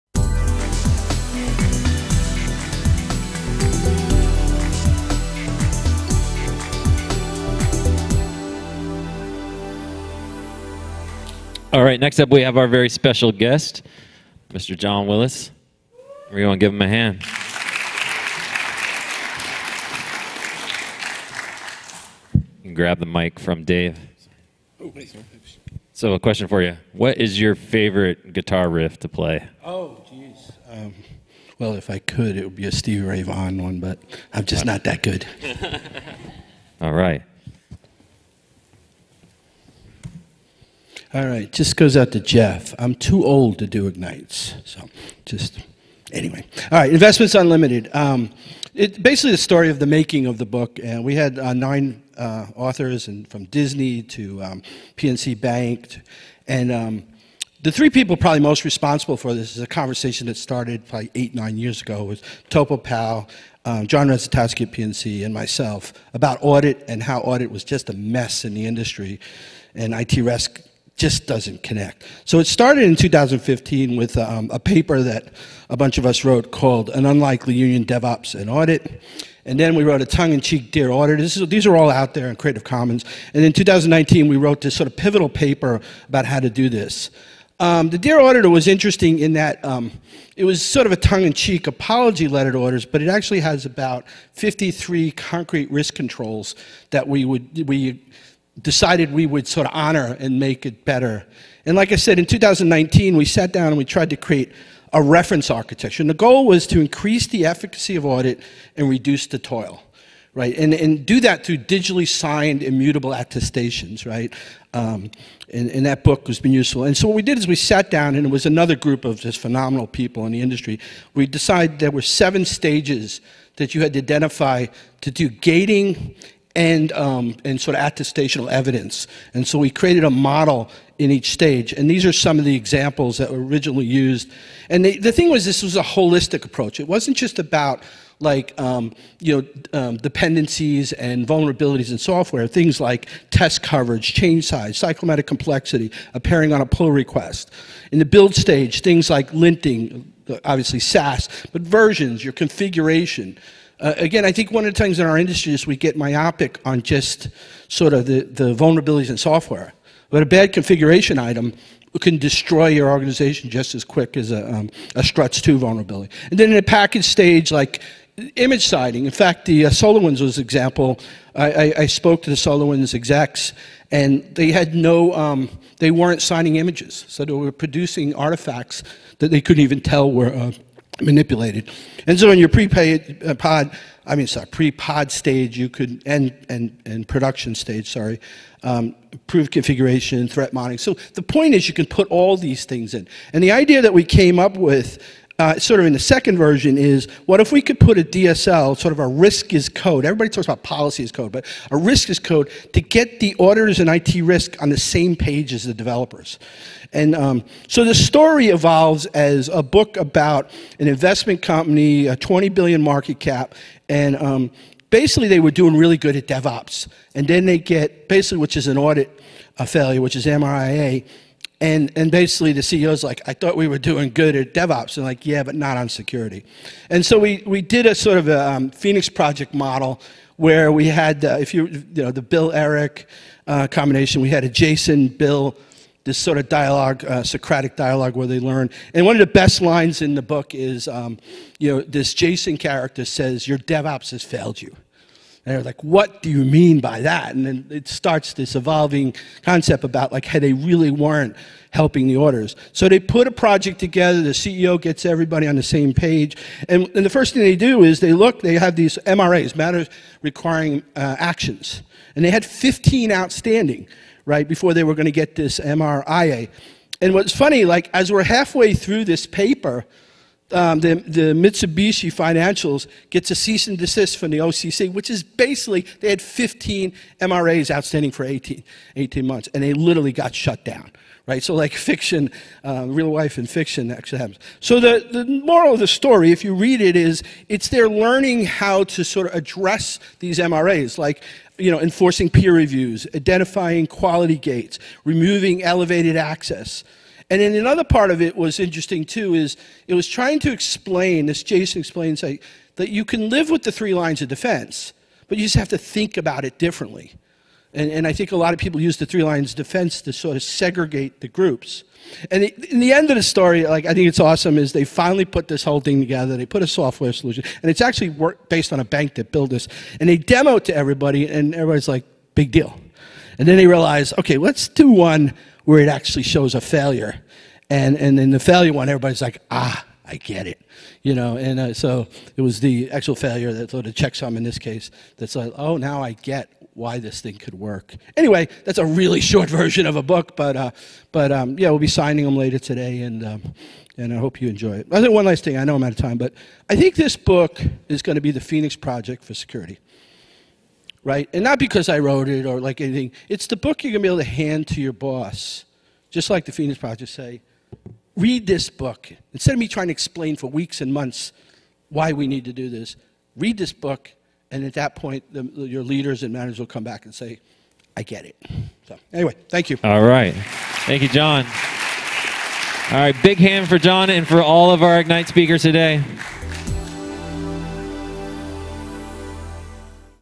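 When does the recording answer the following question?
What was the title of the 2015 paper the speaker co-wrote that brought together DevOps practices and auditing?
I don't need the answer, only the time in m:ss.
1:16.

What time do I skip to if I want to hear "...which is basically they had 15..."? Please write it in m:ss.
4:34.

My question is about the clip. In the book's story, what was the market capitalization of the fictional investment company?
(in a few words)
20 billion.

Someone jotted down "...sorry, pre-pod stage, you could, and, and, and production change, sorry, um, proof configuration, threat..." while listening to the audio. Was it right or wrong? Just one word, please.
wrong.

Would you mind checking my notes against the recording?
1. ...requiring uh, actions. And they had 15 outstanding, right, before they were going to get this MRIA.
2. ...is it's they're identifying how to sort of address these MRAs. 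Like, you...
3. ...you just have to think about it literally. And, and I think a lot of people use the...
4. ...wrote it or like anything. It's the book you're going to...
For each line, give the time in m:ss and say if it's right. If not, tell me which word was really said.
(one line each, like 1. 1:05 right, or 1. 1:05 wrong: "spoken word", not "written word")
1. 4:20 right
2. 4:46 wrong: "learning", not "identifying"
3. 5:05 wrong: "differently", not "literally"
4. 5:51 right.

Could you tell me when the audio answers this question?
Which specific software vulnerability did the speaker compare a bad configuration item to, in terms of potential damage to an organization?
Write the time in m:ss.
2:45.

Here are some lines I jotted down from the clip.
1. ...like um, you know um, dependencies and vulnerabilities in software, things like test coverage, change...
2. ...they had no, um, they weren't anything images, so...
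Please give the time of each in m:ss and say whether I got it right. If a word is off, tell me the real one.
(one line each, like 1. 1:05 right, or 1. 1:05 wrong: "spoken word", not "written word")
1. 2:18 right
2. 2:54 wrong: "signing", not "anything".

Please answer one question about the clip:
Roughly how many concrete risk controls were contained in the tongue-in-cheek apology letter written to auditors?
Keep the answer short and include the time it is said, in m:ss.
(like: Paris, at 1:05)
53, at 1:34.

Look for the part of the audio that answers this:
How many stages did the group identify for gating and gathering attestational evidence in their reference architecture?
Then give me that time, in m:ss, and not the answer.
2:02.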